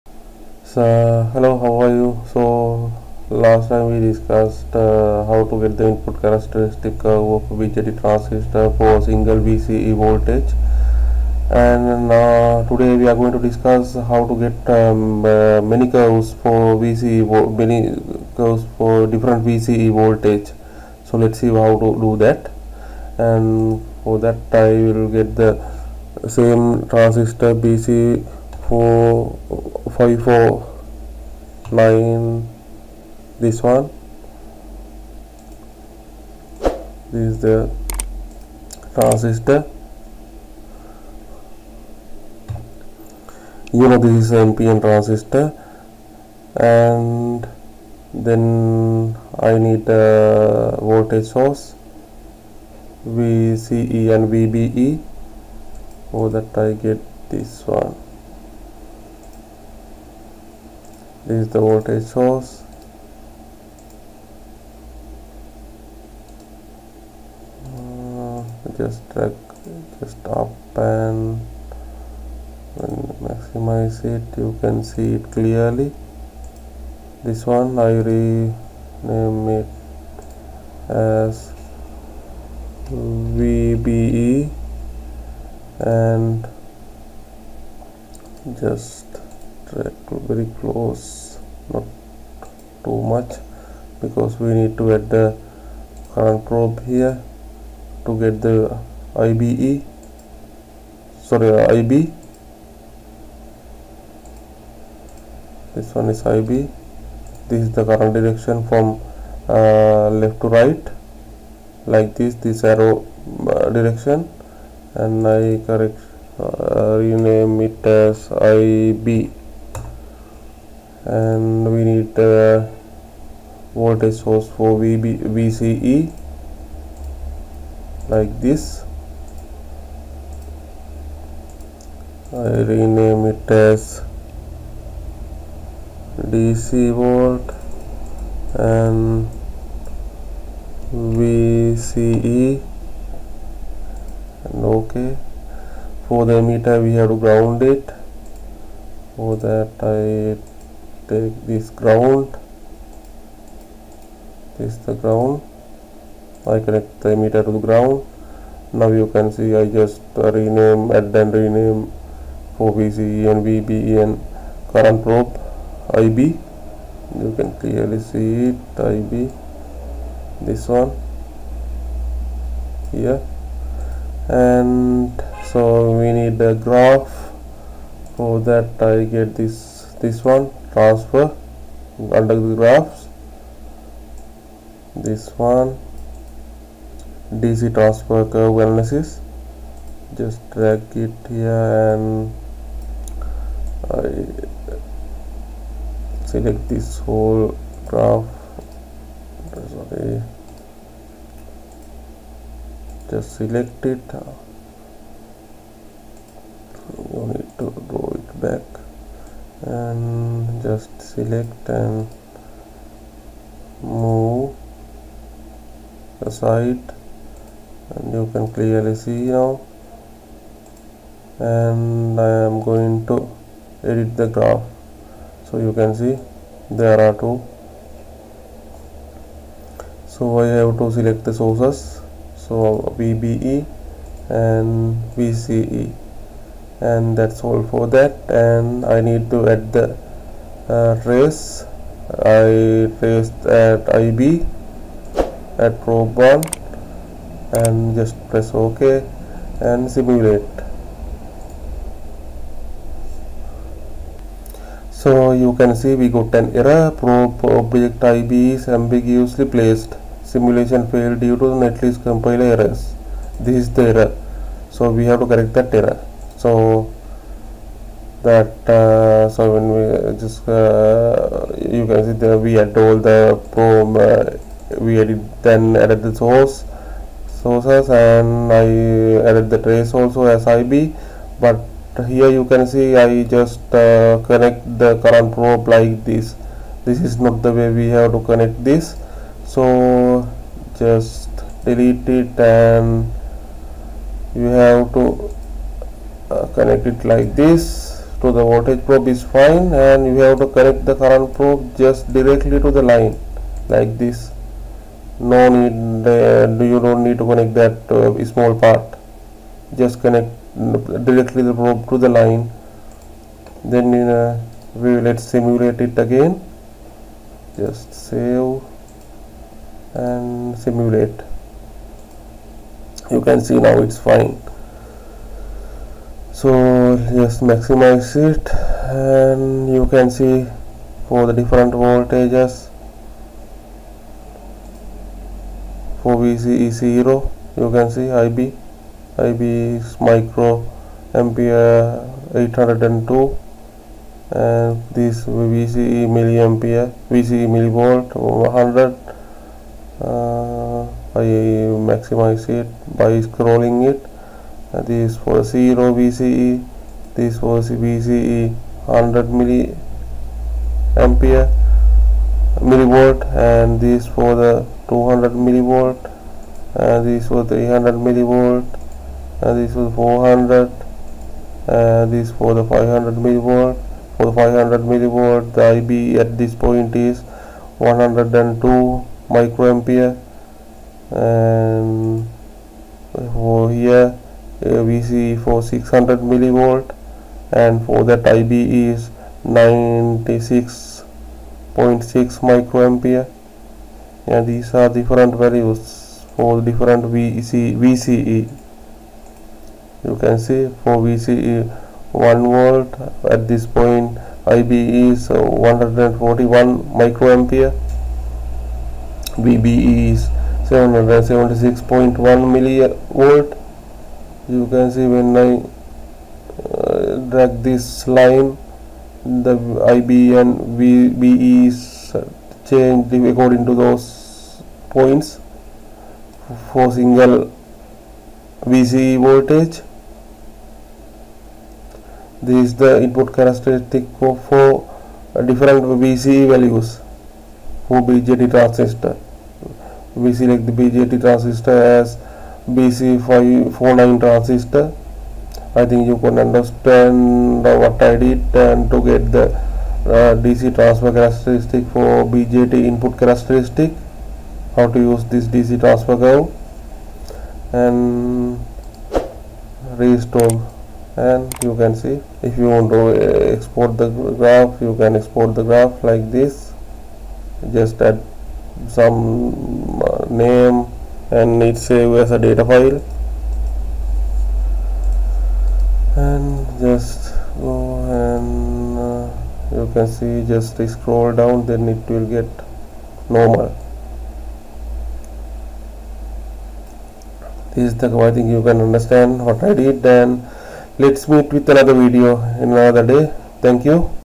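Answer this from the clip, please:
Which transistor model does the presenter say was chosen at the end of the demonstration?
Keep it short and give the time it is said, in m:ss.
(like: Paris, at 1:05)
BC549, at 7:22.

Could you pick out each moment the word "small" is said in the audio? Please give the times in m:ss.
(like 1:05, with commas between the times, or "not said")
5:08.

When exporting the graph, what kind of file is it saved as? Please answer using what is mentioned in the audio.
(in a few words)
data file.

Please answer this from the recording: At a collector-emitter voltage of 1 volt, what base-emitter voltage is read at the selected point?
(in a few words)
776.1 millivolt.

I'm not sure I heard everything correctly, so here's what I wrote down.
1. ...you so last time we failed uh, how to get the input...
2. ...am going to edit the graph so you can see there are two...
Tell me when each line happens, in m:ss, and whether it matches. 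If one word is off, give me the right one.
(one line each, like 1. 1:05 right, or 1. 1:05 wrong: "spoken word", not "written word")
1. 0:01 wrong: "discussed", not "failed"
2. 3:42 right.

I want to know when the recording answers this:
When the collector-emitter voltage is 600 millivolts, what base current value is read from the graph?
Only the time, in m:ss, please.
6:29.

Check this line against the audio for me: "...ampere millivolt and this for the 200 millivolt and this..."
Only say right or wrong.
right.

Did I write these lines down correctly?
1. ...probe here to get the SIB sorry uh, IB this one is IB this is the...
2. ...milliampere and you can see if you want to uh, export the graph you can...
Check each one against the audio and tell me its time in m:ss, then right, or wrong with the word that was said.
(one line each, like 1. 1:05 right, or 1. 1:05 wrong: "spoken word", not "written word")
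1. 1:36 wrong: "IBE", not "SIB"
2. 7:39 wrong: "restore", not "milliampere".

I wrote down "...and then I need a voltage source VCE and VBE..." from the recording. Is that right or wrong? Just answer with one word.
right.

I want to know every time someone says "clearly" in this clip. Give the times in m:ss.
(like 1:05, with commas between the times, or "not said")
1:15, 2:47, 3:38.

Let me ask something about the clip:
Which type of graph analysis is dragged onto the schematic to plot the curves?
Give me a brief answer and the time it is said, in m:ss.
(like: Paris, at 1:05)
DC transfer curve analysis, at 3:07.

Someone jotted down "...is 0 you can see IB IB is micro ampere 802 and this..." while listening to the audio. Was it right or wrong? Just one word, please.
right.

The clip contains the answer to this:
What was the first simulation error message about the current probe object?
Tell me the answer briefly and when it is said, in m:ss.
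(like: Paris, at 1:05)
ambiguously placed, at 4:18.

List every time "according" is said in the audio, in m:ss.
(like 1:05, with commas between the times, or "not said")
7:03.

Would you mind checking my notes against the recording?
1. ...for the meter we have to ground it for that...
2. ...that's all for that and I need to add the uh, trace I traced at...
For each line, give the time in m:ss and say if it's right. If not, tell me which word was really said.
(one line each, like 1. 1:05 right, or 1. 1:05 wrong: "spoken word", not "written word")
1. 2:26 right
2. 3:57 right.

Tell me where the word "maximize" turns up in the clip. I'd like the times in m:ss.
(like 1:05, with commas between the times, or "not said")
1:13, 5:27, 5:51.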